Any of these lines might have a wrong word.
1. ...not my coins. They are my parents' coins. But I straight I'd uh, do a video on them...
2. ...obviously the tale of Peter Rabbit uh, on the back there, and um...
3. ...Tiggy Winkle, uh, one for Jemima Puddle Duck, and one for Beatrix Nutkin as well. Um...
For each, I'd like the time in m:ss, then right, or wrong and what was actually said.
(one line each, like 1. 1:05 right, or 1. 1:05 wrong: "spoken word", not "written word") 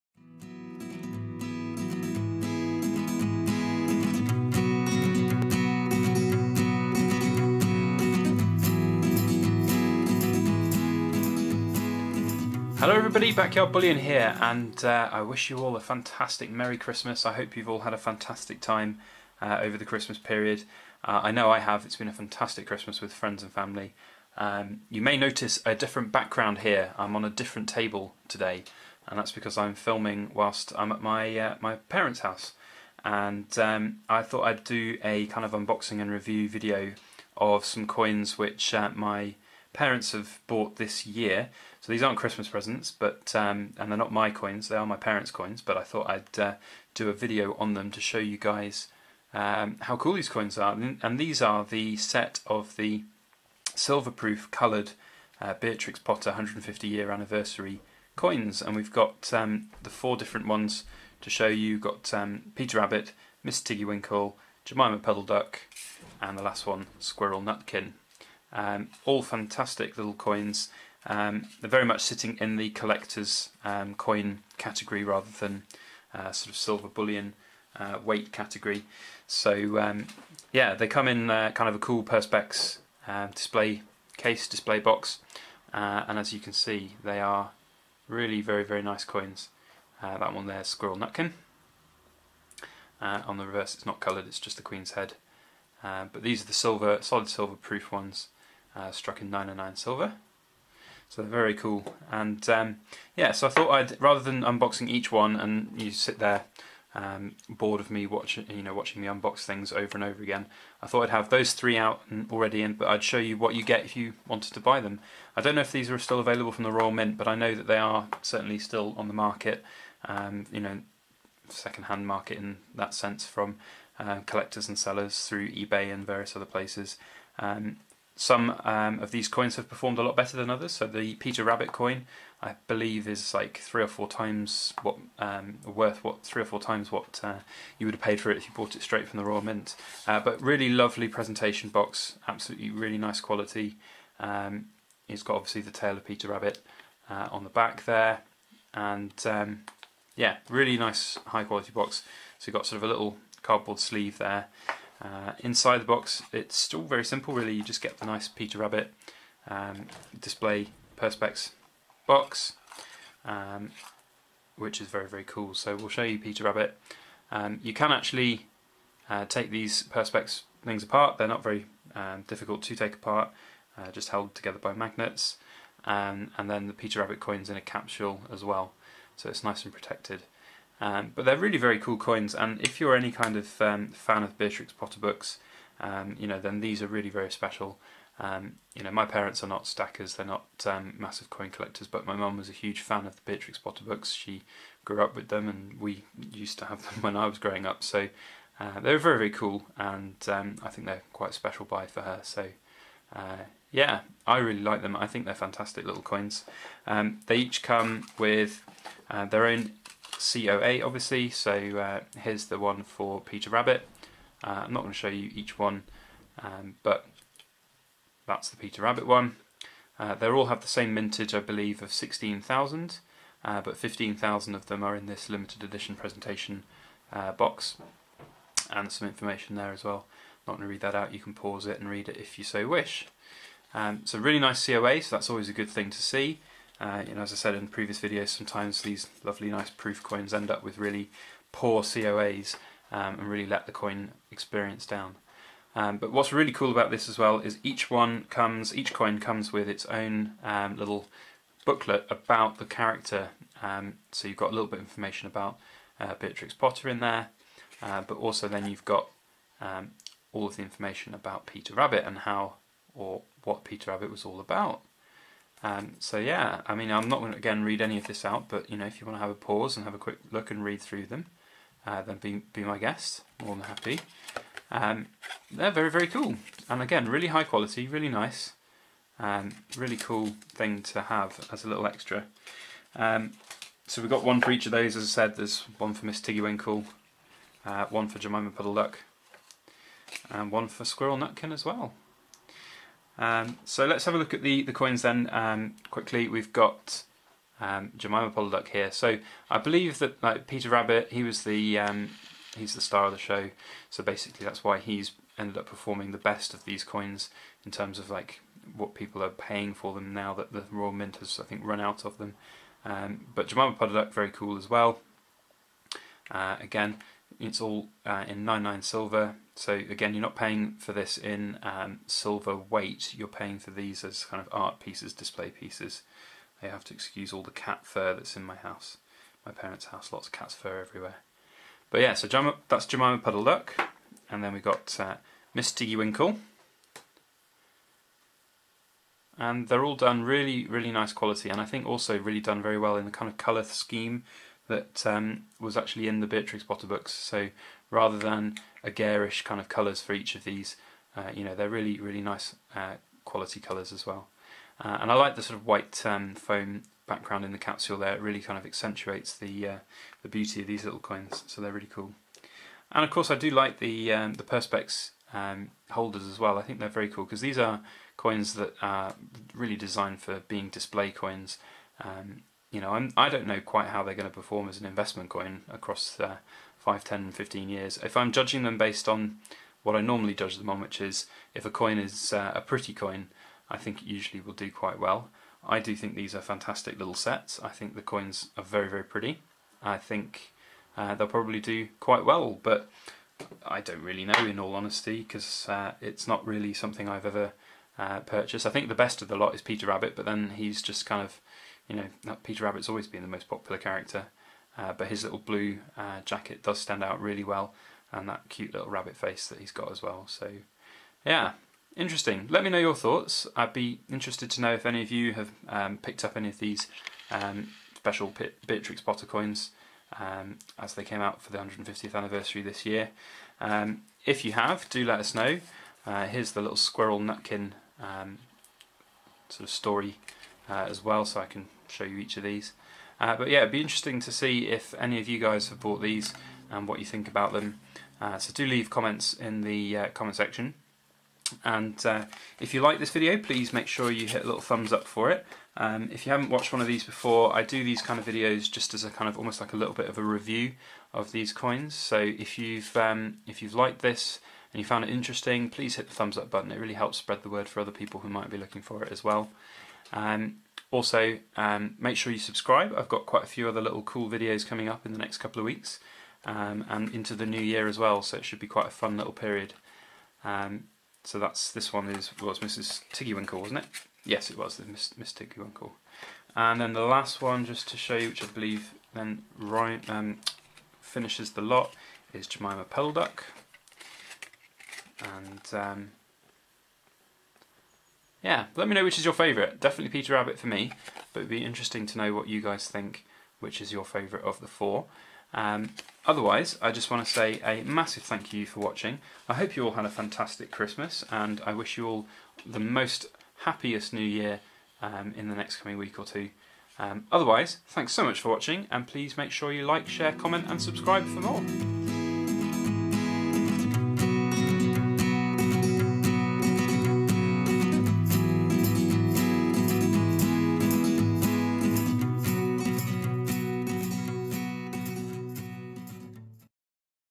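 1. 0:43 wrong: "thought", not "straight"
2. 2:25 right
3. 4:46 wrong: "Squirrel", not "Beatrix".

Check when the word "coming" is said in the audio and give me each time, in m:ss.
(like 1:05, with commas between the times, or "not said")
7:44, 8:25.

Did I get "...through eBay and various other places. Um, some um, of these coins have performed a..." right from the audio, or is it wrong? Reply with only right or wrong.
right.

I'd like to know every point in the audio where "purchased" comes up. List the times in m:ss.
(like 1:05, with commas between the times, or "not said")
6:38.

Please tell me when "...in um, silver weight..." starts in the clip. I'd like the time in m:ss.
5:21.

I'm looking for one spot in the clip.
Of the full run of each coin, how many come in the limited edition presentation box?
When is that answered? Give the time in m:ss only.
3:43.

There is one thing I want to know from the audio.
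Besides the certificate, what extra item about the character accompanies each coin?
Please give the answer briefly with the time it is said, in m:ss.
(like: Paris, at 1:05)
Little booklet, at 4:10.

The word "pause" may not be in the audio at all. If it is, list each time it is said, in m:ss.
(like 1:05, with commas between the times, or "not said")
3:51, 4:29.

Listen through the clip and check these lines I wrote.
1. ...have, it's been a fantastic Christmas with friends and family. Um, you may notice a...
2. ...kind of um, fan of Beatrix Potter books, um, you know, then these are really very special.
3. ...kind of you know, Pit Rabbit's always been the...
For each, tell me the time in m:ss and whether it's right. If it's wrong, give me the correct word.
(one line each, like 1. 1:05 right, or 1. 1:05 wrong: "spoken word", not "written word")
1. 0:21 right
2. 3:03 right
3. 6:41 wrong: "Peter", not "Pit".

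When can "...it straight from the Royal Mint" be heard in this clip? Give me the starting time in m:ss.
2:18.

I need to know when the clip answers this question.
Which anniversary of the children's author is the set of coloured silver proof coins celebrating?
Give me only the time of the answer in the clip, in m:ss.
0:56.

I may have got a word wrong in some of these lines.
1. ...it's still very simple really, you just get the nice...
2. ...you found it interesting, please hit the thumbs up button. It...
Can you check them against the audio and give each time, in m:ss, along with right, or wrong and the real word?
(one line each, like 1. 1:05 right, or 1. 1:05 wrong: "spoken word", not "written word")
1. 2:36 right
2. 7:34 right.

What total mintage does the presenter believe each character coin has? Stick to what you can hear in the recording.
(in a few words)
16,000.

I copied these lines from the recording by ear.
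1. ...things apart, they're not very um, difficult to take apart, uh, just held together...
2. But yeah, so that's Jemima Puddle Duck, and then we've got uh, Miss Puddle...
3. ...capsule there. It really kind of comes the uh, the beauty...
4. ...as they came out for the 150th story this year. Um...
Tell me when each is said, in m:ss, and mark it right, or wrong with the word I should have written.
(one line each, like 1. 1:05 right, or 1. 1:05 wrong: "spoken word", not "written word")
1. 2:50 right
2. 5:31 wrong: "Tiggy", not "Puddle"
3. 5:57 wrong: "accentuates", not "comes"
4. 7:00 wrong: "anniversary", not "story".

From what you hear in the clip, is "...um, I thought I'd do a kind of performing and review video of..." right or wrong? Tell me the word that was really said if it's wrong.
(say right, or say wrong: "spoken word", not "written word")
wrong: "unboxing", not "performing".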